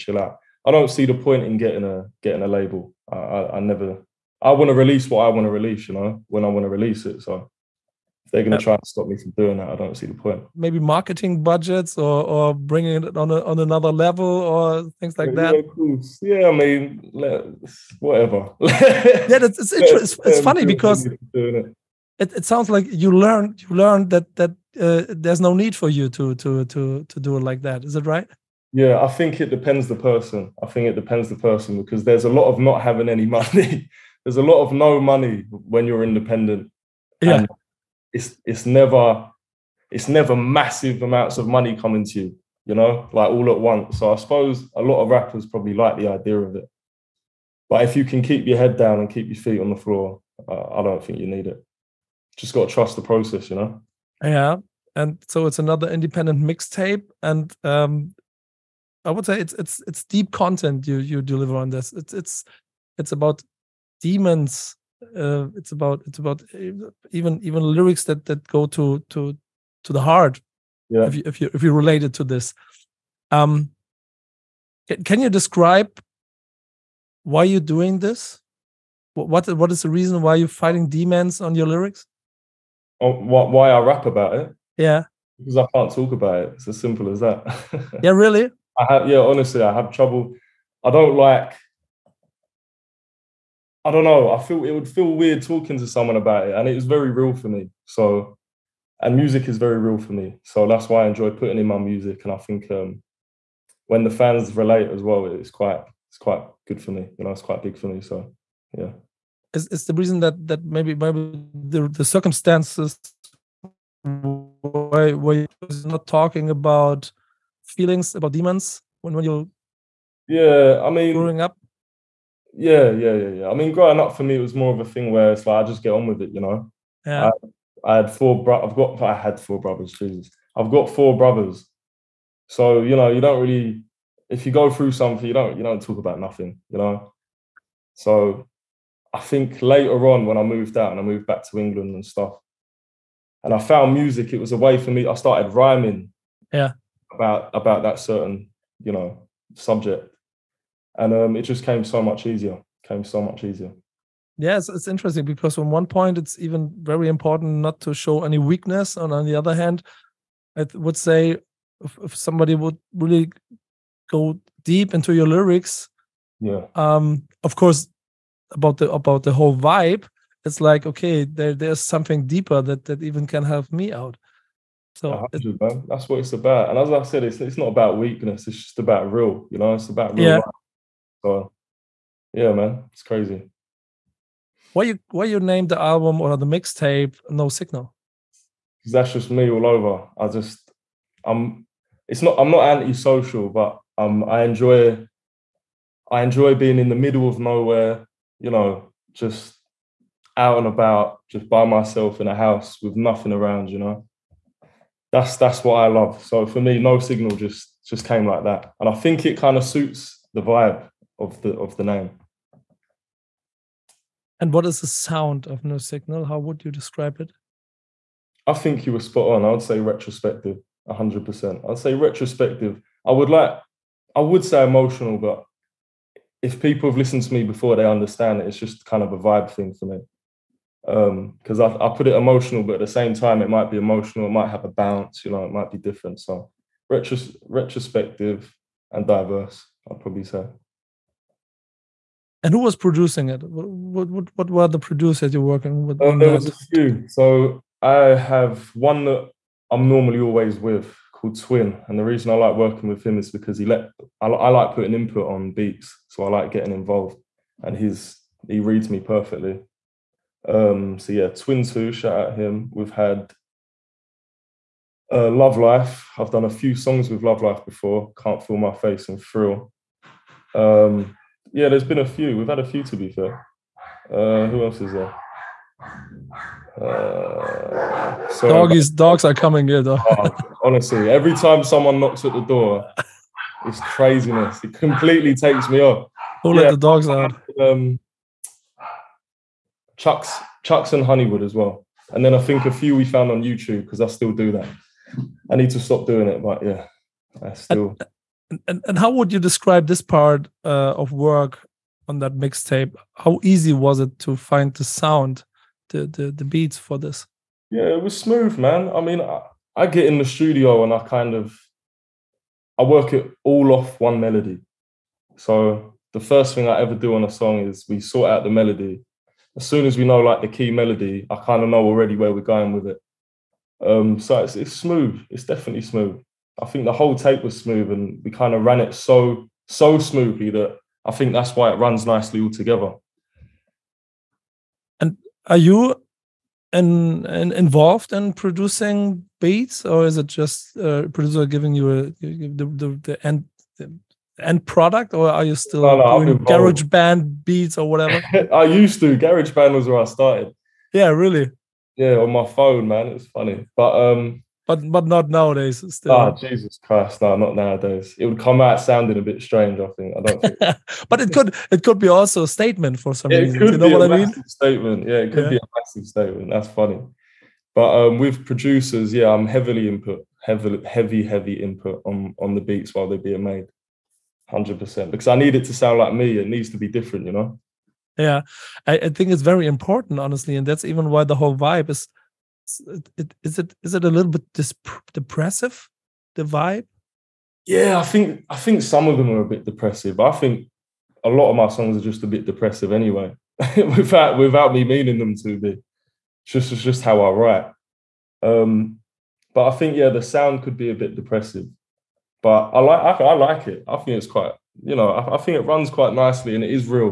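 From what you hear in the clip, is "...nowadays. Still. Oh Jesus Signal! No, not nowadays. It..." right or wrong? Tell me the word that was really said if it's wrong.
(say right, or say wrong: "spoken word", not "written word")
wrong: "Christ", not "Signal".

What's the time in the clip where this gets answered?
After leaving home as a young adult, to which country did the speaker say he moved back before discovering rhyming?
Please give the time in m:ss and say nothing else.
2:21.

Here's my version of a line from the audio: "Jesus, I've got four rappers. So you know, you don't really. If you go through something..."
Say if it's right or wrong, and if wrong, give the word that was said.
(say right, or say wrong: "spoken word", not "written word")
wrong: "brothers", not "rappers".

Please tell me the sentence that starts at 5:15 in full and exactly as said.
So the first thing I ever do on a song is we sort out the melody.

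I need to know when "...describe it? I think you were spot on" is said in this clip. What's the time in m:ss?
3:36.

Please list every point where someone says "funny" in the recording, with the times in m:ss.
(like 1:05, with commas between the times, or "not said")
0:20, 5:53, 6:06.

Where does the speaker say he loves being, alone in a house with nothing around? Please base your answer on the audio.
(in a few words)
In the middle of nowhere.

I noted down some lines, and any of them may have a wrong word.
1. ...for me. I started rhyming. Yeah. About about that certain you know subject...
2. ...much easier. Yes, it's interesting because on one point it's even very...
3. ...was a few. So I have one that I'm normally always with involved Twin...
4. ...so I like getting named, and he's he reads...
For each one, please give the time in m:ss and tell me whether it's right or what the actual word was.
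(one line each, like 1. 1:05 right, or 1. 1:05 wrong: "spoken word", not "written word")
1. 2:24 right
2. 2:33 right
3. 4:06 wrong: "called", not "involved"
4. 4:16 wrong: "involved", not "named".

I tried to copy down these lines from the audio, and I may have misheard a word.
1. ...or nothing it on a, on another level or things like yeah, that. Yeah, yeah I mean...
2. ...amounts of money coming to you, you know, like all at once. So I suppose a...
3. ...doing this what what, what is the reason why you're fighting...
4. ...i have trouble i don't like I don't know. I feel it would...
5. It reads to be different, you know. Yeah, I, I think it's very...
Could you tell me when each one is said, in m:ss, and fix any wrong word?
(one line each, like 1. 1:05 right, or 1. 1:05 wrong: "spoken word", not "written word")
1. 0:12 wrong: "bringing", not "nothing"
2. 0:41 right
3. 1:17 right
4. 1:29 right
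5. 6:16 wrong: "needs", not "reads".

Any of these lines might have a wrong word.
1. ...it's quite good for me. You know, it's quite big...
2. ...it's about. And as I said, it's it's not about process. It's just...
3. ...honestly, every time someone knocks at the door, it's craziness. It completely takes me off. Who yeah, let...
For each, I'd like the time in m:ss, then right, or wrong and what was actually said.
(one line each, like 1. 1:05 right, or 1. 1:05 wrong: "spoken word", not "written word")
1. 1:46 right
2. 2:56 wrong: "weakness", not "process"
3. 4:40 right.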